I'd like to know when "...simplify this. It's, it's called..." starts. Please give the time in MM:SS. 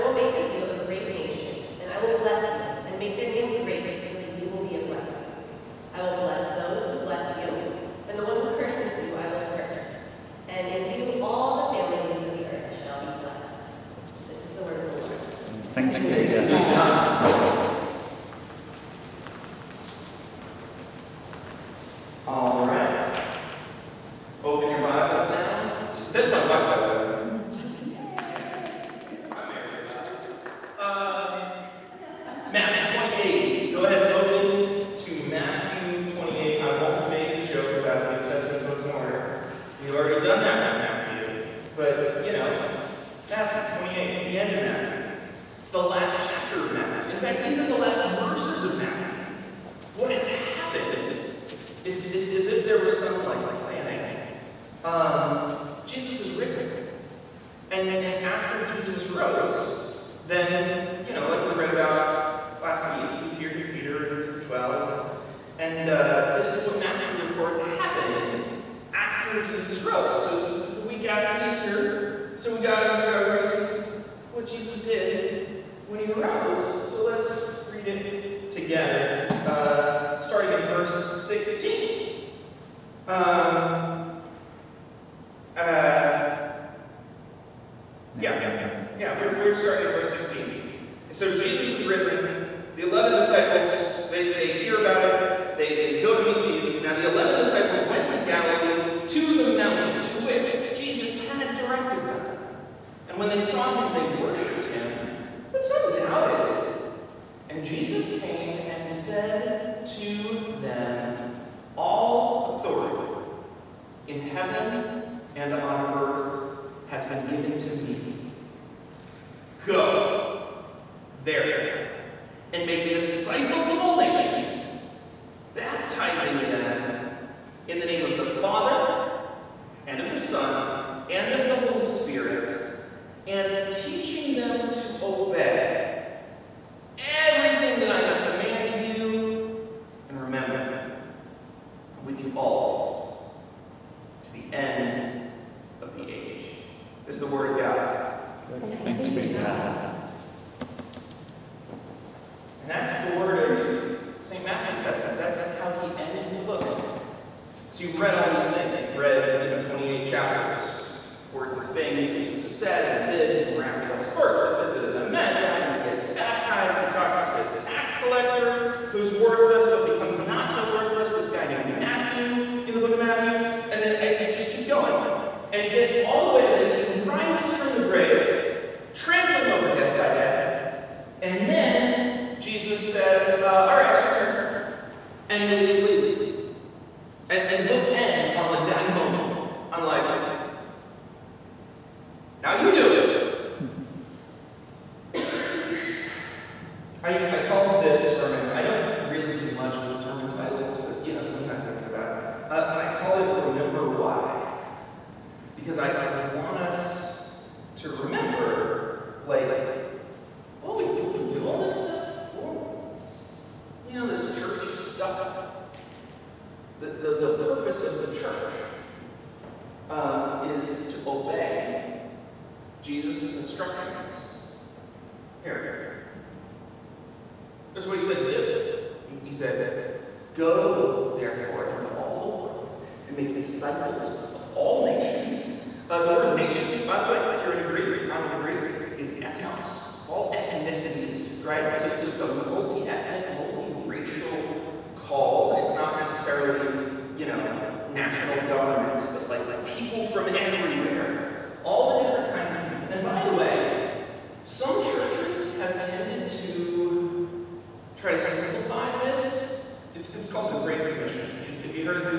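04:18.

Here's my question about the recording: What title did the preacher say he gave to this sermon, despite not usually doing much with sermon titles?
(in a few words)
Remember Why.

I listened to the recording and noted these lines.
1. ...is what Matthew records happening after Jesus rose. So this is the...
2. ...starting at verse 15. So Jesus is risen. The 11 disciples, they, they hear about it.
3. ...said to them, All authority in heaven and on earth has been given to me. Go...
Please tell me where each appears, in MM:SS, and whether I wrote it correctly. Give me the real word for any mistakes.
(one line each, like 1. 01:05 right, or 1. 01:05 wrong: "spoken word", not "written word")
1. 01:06 right
2. 01:29 wrong: "16", not "15"
3. 01:48 right.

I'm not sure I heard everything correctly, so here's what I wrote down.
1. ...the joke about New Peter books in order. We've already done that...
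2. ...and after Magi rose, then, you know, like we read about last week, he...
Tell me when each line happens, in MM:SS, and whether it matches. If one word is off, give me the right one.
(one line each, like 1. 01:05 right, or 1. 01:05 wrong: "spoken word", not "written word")
1. 00:37 wrong: "Testament", not "Peter"
2. 00:57 wrong: "Jesus", not "Magi".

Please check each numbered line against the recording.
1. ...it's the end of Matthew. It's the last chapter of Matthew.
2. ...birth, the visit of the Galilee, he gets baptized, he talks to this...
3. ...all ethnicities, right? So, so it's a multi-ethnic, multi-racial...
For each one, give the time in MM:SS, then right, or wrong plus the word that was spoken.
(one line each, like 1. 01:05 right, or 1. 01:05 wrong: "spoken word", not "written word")
1. 00:44 right
2. 02:44 wrong: "Magi", not "Galilee"
3. 04:00 right.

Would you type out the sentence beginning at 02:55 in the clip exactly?
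And he gets all the way to this, he rises from the grave, he leaves.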